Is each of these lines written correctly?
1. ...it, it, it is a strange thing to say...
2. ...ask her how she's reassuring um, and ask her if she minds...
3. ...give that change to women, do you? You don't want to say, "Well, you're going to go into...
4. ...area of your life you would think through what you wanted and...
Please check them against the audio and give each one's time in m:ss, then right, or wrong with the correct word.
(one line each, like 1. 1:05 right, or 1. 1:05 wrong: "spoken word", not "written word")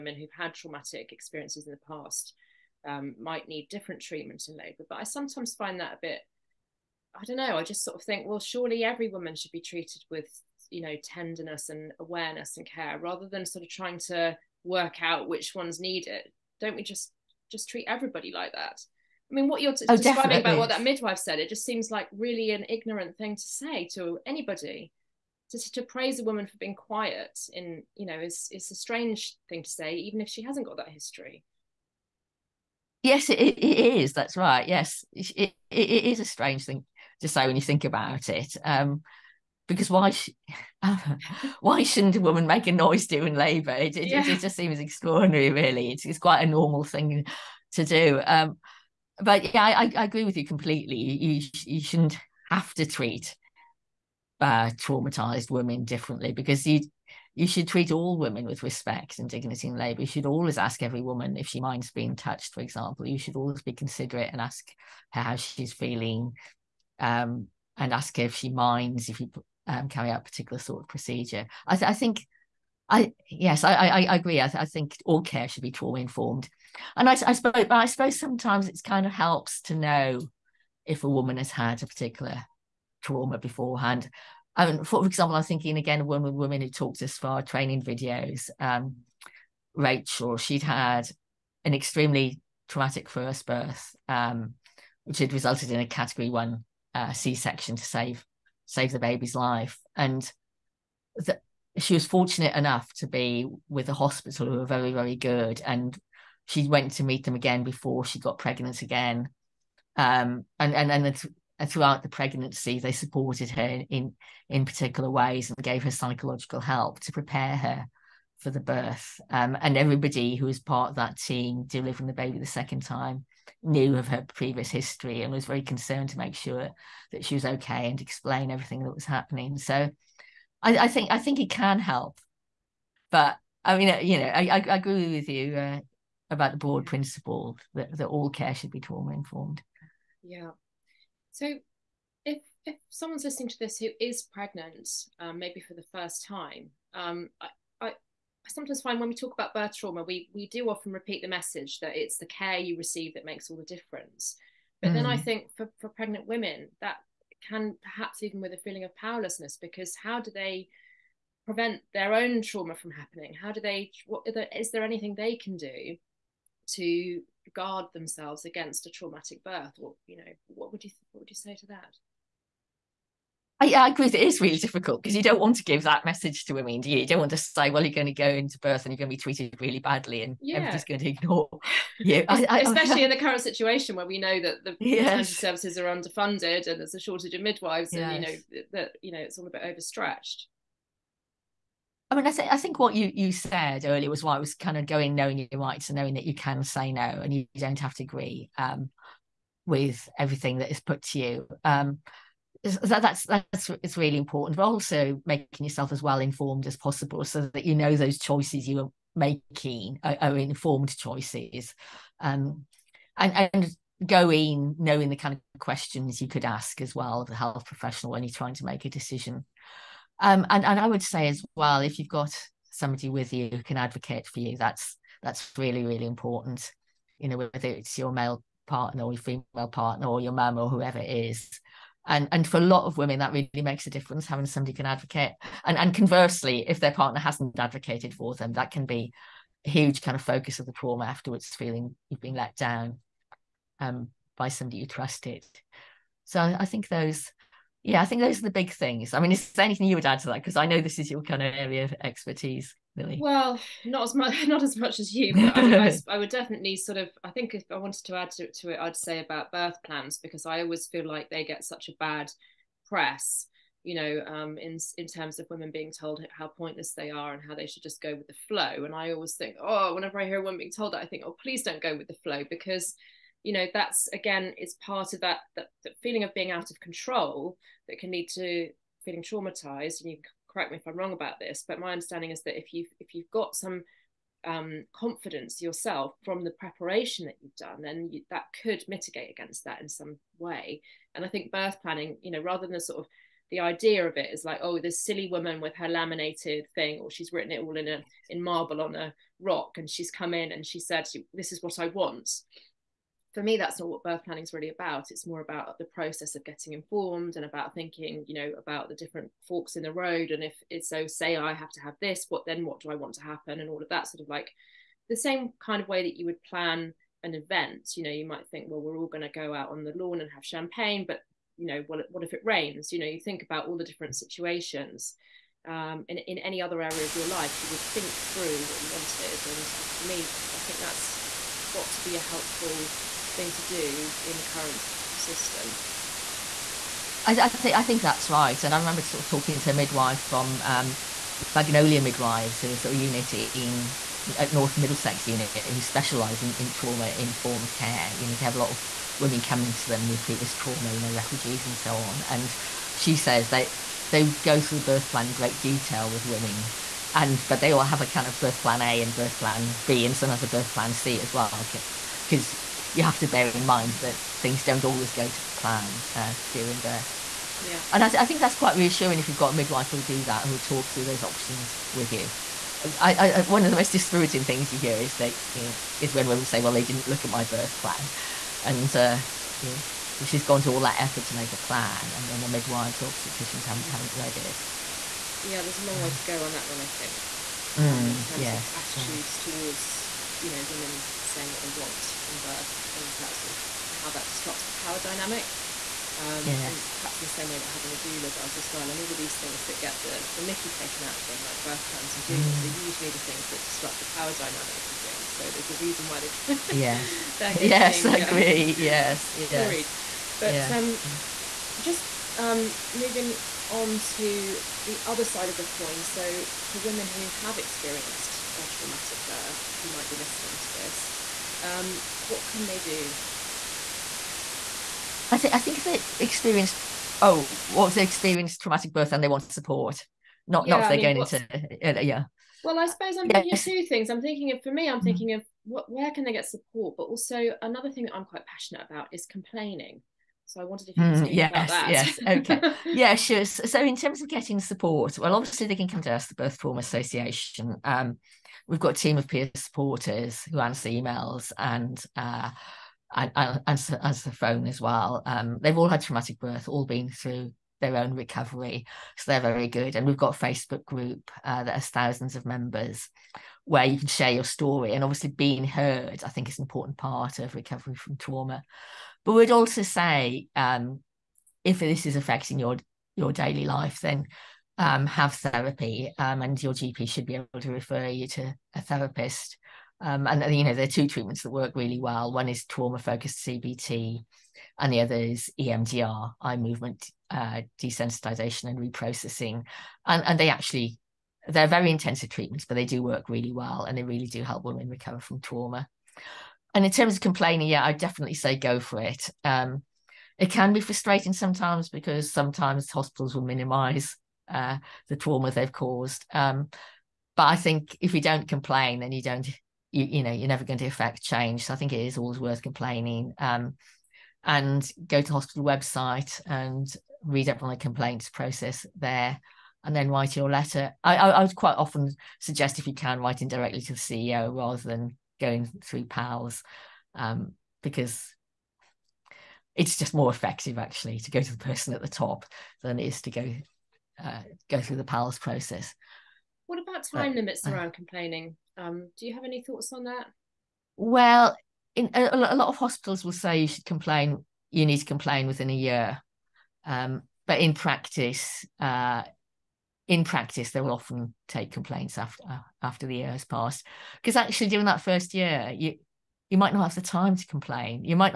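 1. 0:35 right
2. 1:04 wrong: "feeling", not "reassuring"
3. 2:55 wrong: "message", not "change"
4. 5:26 right.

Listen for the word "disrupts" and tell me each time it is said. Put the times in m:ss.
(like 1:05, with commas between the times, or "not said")
6:34, 6:43.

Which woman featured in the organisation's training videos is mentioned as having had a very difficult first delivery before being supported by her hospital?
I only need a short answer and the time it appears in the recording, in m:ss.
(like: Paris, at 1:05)
Rachel, at 1:29.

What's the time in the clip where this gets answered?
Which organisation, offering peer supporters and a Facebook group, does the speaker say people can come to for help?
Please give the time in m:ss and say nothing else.
7:26.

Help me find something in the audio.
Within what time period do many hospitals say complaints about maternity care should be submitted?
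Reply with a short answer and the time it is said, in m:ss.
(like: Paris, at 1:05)
a year, at 9:05.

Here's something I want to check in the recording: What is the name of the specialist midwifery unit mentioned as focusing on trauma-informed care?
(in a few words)
Magnolia Midwives.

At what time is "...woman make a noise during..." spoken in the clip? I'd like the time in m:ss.
0:42.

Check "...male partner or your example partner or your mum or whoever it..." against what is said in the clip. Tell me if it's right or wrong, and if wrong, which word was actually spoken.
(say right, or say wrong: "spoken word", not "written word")
wrong: "female", not "example".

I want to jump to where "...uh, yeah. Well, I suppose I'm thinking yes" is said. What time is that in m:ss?
7:11.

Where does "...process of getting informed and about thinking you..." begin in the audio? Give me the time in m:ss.
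5:05.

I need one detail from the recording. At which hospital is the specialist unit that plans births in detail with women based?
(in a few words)
North Middlesex.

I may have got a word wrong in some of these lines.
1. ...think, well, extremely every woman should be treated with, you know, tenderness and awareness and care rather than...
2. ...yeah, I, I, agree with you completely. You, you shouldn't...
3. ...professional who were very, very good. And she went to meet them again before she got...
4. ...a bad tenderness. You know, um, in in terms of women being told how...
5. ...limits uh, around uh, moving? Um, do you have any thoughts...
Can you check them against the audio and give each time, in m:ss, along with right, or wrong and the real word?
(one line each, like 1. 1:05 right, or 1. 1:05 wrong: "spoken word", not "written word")
1. 0:08 wrong: "surely", not "extremely"
2. 0:49 right
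3. 1:43 wrong: "hospital", not "professional"
4. 4:21 wrong: "press", not "tenderness"
5. 8:57 wrong: "complaining", not "moving".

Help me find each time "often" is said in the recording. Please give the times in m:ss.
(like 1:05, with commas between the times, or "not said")
2:30, 8:41, 9:10.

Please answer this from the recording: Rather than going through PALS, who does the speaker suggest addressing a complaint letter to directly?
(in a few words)
the CEO.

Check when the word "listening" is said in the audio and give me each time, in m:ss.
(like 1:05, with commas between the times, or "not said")
2:23, 7:00.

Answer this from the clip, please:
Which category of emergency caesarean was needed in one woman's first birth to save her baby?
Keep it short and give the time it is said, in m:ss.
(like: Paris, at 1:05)
category one, at 1:35.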